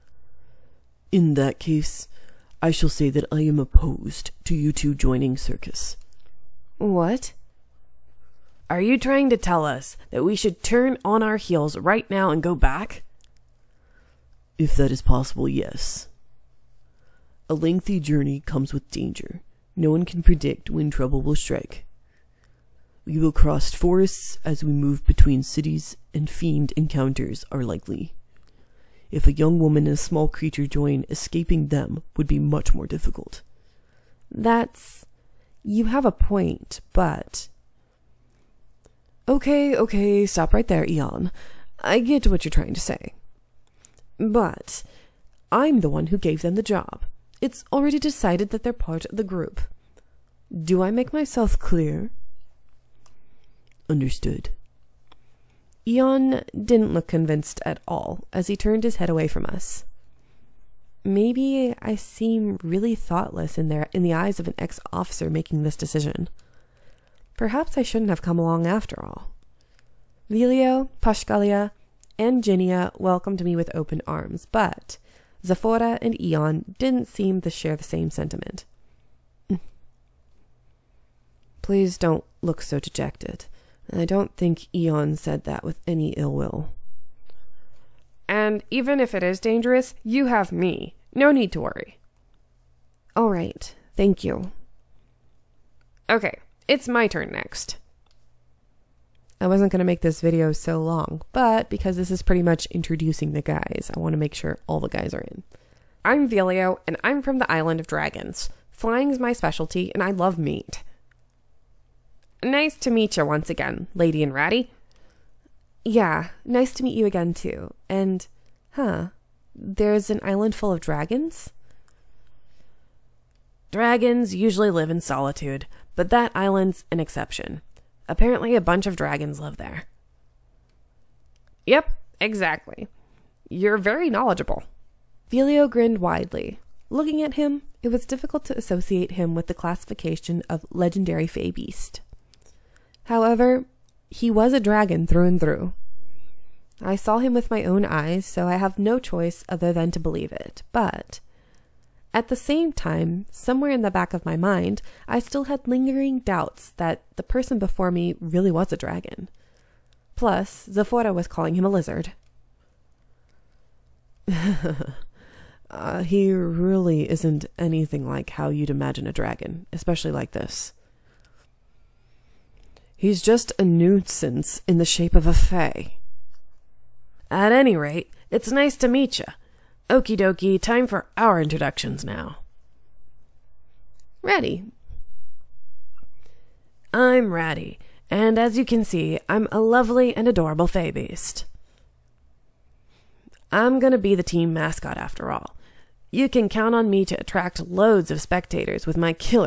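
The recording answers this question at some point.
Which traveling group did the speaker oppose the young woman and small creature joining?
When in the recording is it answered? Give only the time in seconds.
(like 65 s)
5 s.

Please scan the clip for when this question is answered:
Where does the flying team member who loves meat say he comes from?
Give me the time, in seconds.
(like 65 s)
107 s.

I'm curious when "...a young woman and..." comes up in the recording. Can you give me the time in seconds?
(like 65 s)
29 s.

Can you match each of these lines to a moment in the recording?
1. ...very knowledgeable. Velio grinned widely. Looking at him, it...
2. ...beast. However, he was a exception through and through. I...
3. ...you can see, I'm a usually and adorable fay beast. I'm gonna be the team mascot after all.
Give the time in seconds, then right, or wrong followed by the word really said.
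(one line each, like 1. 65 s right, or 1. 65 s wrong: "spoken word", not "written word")
1. 133 s right
2. 141 s wrong: "dragon", not "exception"
3. 188 s wrong: "lovely", not "usually".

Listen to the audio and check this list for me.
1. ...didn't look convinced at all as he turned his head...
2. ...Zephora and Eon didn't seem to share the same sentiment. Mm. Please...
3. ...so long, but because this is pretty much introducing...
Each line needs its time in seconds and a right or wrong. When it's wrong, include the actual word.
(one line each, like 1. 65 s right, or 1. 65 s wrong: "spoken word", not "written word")
1. 56 s right
2. 75 s right
3. 100 s right.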